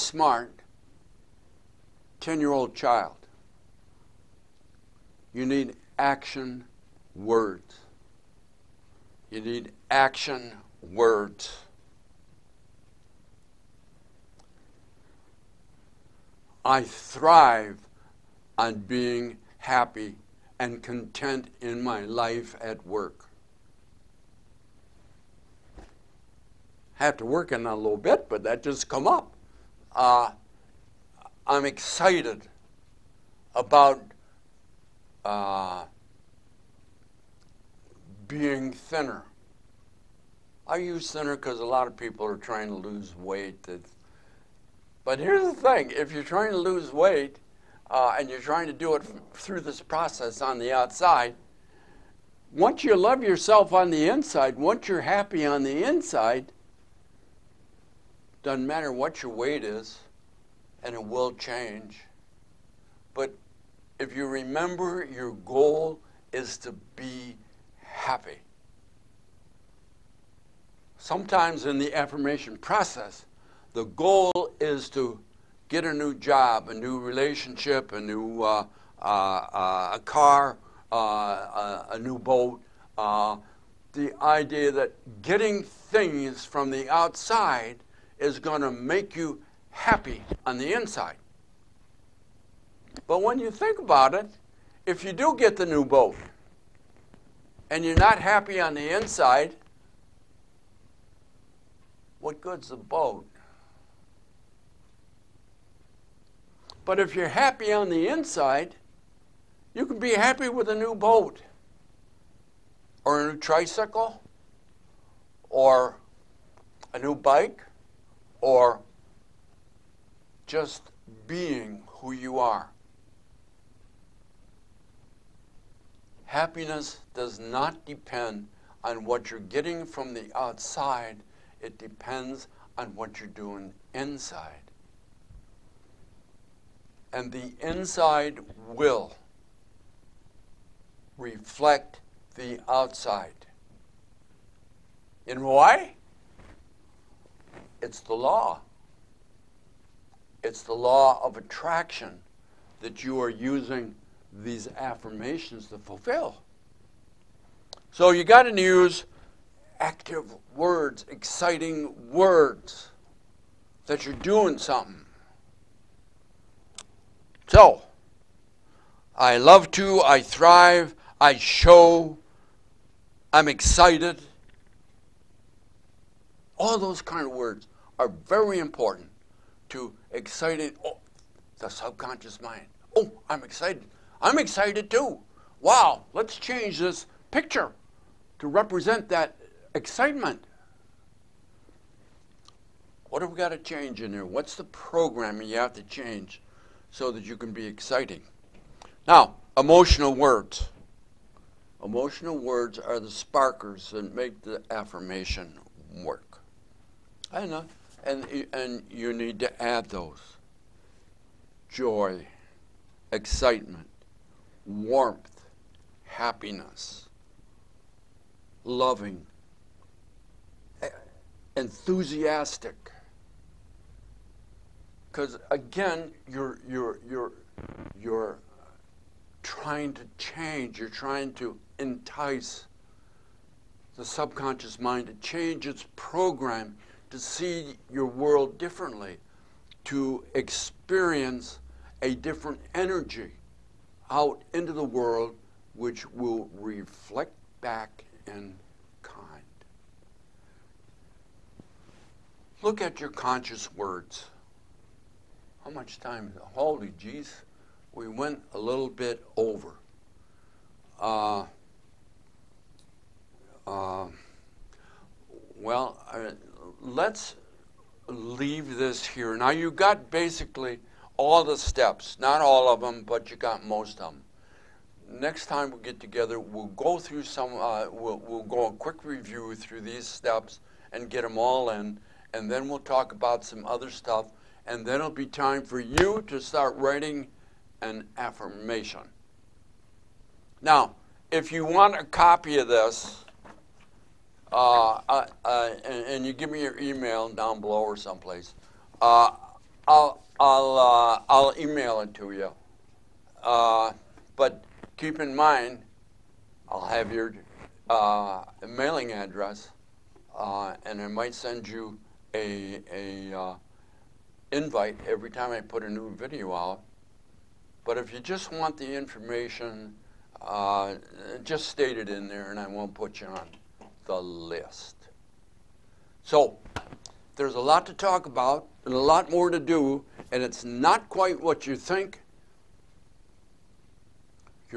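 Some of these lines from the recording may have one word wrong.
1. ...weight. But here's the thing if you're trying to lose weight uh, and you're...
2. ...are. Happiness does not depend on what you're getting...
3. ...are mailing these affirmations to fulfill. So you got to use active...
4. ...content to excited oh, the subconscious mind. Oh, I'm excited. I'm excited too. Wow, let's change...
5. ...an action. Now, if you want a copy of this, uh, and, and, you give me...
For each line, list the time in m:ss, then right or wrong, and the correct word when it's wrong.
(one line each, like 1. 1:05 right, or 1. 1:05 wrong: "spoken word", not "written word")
1. 0:43 right
2. 2:02 right
3. 2:33 wrong: "using", not "mailing"
4. 2:58 wrong: "important", not "content"
5. 4:47 wrong: "affirmation", not "action".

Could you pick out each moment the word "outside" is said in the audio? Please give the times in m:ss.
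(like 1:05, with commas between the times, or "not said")
0:50, 1:26, 2:10, 2:22.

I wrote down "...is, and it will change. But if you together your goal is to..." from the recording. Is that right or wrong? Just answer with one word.
wrong.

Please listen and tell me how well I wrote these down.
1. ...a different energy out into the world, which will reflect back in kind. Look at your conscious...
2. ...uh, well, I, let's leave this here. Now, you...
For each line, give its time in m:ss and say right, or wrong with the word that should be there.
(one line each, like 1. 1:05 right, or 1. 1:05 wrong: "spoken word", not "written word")
1. 4:02 right
2. 4:23 right.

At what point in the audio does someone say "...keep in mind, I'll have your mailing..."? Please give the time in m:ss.
5:04.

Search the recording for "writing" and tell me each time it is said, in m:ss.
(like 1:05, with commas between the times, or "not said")
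4:46.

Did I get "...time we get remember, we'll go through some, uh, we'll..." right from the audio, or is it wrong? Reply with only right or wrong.
wrong.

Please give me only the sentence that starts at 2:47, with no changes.
So, I love to, I thrive, I show, I'm excited.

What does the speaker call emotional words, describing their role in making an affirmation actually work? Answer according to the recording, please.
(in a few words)
sparkers.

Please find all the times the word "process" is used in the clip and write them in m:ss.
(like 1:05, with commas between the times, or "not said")
0:49, 1:12.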